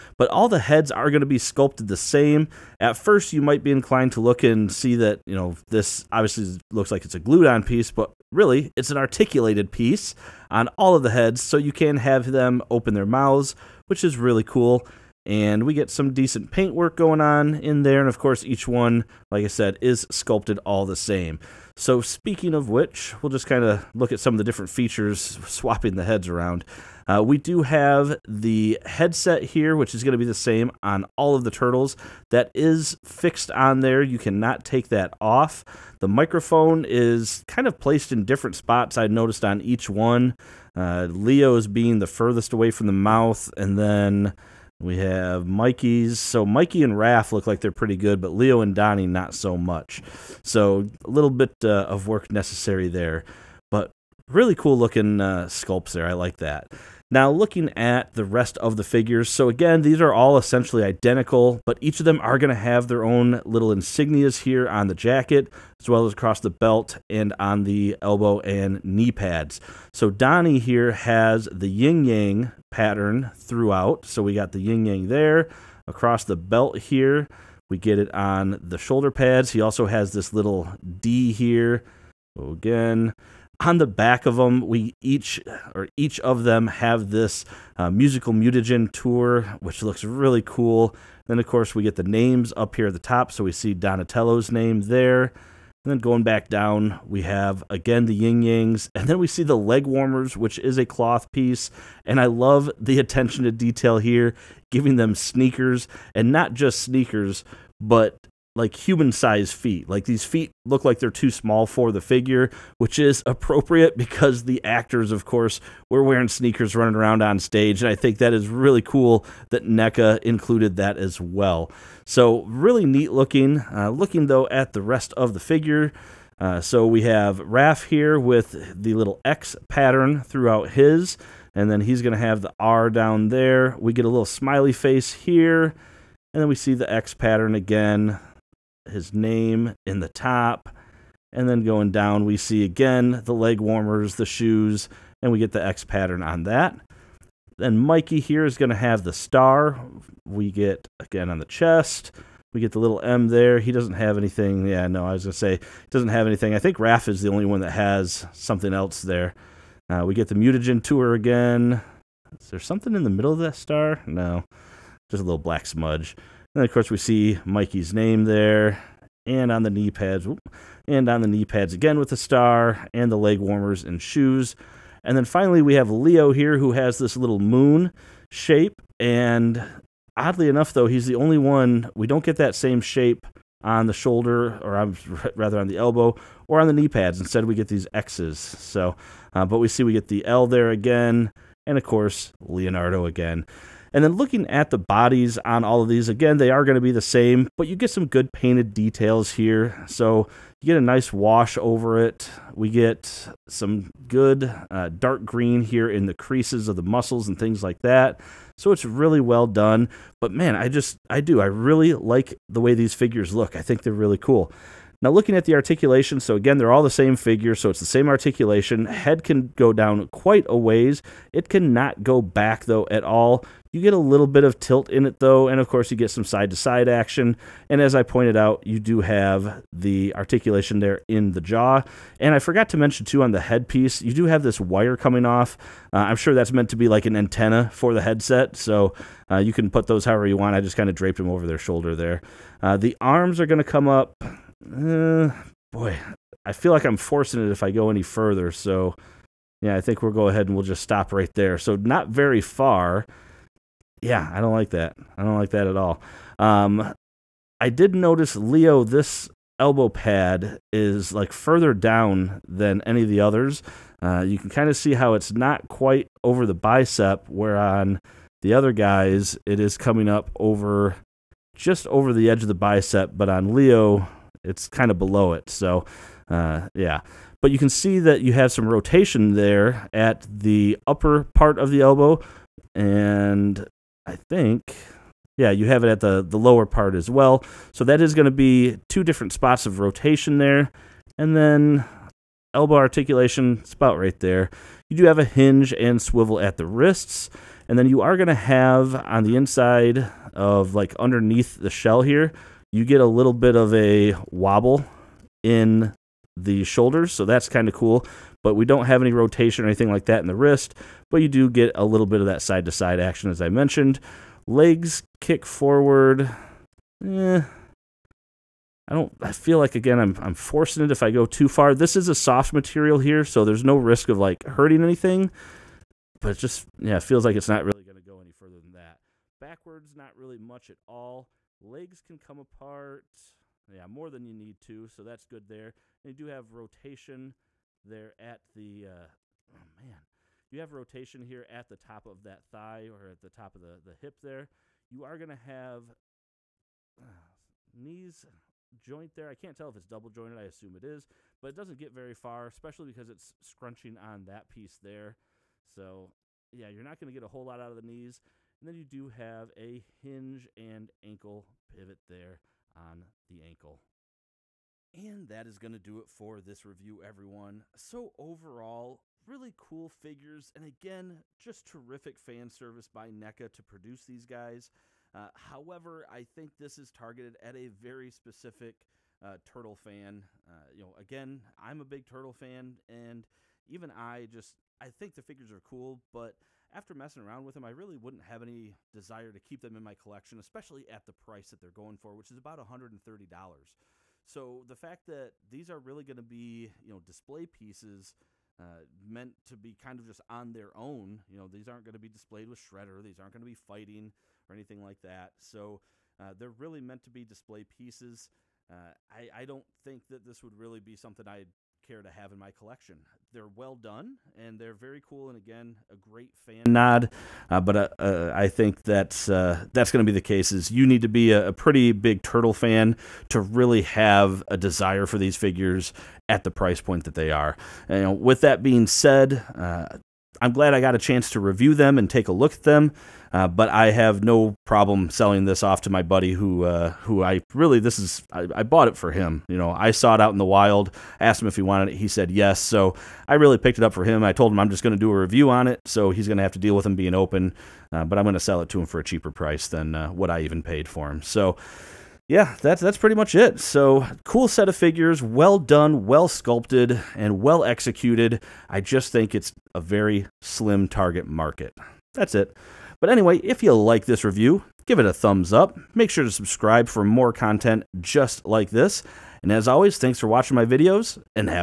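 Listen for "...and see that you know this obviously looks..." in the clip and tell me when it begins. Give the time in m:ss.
0:04.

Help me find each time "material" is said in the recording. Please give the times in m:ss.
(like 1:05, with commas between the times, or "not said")
5:22.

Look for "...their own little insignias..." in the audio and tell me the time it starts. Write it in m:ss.
1:02.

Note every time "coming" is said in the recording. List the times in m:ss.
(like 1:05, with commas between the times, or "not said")
3:54, 4:29.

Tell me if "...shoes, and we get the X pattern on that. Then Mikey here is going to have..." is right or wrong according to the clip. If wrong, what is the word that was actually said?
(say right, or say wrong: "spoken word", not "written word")
right.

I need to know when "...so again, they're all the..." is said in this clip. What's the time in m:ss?
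3:36.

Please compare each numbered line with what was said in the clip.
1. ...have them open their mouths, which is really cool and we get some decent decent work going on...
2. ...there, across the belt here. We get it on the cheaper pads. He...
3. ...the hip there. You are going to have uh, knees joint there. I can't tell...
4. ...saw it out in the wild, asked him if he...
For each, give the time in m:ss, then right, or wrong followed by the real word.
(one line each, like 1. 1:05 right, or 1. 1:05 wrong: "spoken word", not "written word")
1. 0:11 wrong: "paint", not "decent"
2. 1:15 wrong: "shoulder", not "cheaper"
3. 5:43 right
4. 7:19 right.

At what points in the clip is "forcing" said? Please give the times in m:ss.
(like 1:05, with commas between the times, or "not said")
4:06, 5:20.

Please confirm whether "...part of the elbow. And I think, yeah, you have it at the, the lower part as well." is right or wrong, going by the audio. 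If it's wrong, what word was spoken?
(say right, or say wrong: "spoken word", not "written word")
right.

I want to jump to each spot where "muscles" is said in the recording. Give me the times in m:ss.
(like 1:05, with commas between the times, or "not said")
3:26.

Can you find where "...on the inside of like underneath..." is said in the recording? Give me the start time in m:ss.
4:58.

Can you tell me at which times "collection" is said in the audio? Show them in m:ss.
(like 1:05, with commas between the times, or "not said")
6:29, 6:52.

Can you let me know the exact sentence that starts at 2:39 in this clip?
Uh, we get the mutagen tour again.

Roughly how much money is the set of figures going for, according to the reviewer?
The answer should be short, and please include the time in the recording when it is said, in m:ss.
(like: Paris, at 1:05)
$130, at 6:32.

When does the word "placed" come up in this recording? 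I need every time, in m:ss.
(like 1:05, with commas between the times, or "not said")
0:37.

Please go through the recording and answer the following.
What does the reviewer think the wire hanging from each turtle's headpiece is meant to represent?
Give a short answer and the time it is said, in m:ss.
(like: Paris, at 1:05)
An antenna, at 3:57.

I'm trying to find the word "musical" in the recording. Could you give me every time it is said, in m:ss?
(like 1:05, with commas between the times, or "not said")
1:27.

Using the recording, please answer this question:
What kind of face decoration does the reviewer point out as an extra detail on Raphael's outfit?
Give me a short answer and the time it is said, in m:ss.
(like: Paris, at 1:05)
Smiley face, at 2:14.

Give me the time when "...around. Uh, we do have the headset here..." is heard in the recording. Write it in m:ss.
0:26.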